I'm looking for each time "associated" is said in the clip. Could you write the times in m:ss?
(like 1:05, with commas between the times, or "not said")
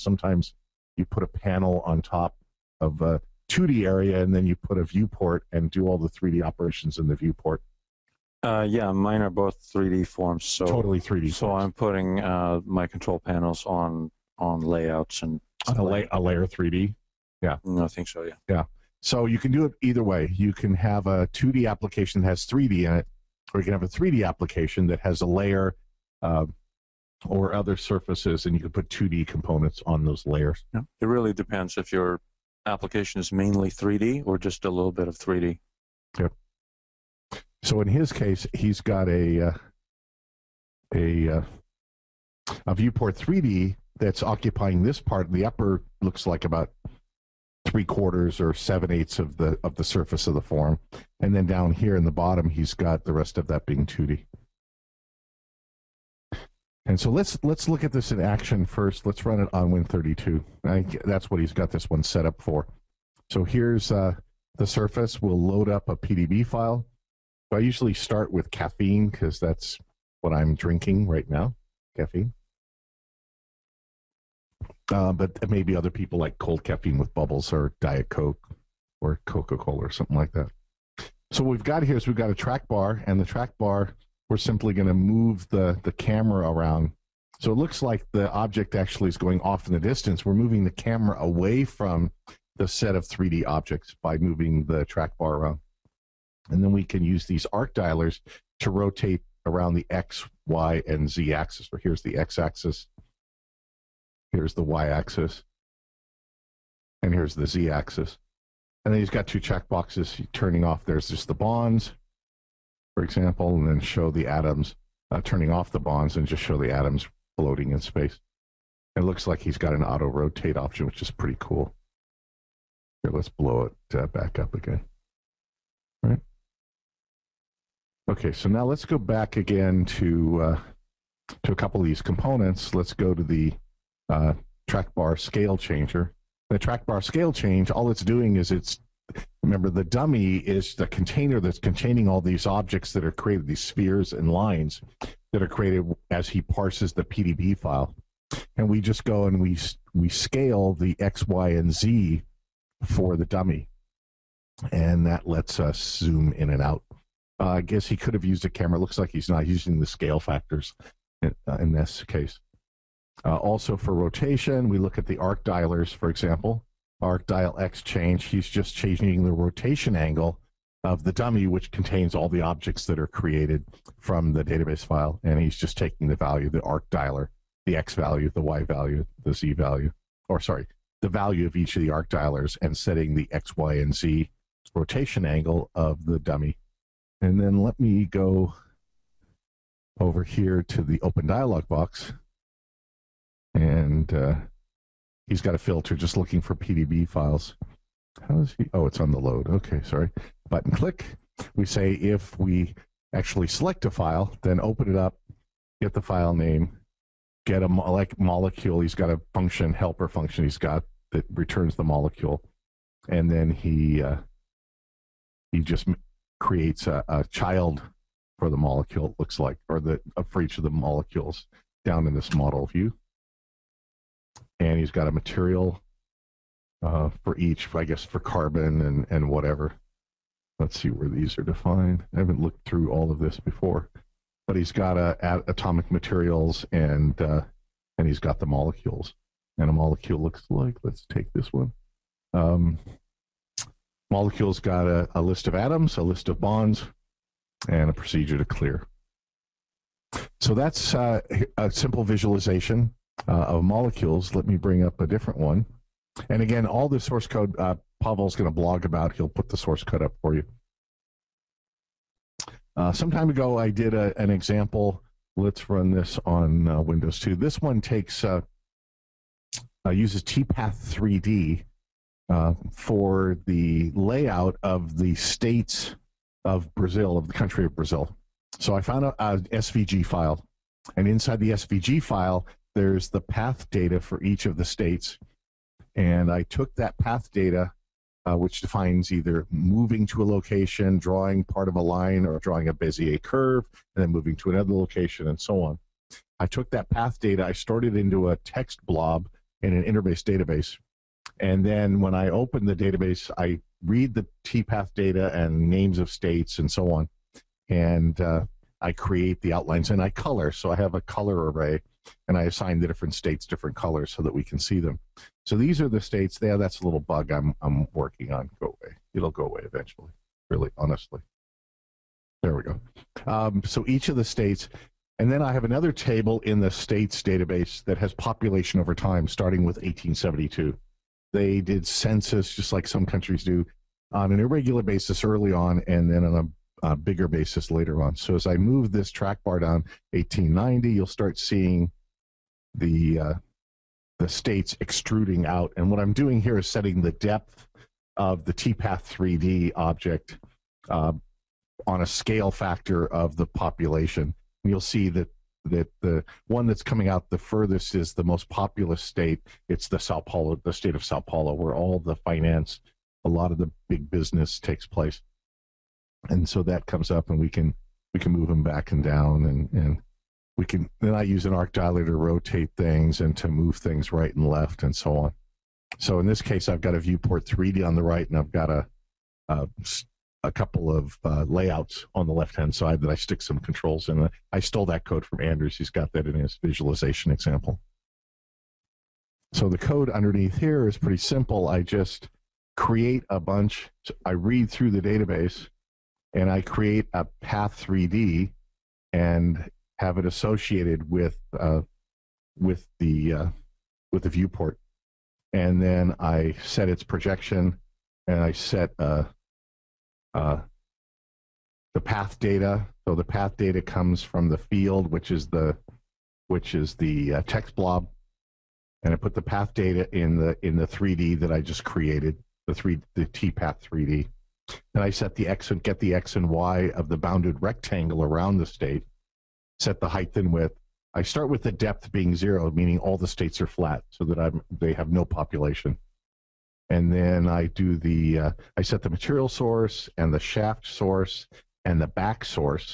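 6:40.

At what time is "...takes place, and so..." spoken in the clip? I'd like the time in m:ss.
6:04.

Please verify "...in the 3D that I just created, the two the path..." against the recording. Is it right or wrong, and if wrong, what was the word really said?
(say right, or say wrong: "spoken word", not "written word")
wrong: "three", not "two".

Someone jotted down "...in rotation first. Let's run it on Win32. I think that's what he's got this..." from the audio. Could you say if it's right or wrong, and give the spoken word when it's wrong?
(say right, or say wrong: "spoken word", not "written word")
wrong: "action", not "rotation".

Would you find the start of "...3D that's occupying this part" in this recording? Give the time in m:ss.
0:43.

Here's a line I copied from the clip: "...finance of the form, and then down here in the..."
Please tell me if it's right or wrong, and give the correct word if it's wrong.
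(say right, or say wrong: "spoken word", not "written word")
wrong: "surface", not "finance".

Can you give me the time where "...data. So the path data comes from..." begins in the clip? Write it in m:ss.
6:52.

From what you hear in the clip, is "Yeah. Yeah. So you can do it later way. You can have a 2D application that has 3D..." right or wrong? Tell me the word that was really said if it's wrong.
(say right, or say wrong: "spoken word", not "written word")
wrong: "either", not "later".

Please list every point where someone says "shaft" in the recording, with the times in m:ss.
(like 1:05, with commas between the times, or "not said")
7:20.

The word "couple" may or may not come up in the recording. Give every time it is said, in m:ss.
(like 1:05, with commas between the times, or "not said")
2:11, 6:20.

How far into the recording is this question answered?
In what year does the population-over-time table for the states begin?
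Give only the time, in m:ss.
5:29.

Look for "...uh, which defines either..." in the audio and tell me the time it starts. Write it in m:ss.
4:48.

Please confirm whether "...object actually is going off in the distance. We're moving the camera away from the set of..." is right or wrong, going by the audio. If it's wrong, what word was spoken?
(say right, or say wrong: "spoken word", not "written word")
right.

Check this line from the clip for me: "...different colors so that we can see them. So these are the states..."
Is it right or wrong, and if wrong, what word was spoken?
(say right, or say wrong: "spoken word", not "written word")
right.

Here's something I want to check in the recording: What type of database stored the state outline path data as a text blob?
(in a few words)
InterBase.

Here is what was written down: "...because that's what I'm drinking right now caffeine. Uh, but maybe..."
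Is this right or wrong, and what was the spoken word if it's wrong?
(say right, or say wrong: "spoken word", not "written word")
right.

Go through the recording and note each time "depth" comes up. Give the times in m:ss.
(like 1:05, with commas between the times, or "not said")
5:47, 7:11.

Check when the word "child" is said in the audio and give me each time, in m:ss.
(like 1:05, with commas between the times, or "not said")
3:37.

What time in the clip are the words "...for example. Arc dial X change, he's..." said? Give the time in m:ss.
2:45.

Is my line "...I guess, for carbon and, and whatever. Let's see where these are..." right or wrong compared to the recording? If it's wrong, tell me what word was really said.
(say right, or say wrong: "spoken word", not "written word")
right.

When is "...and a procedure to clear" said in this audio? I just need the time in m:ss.
4:07.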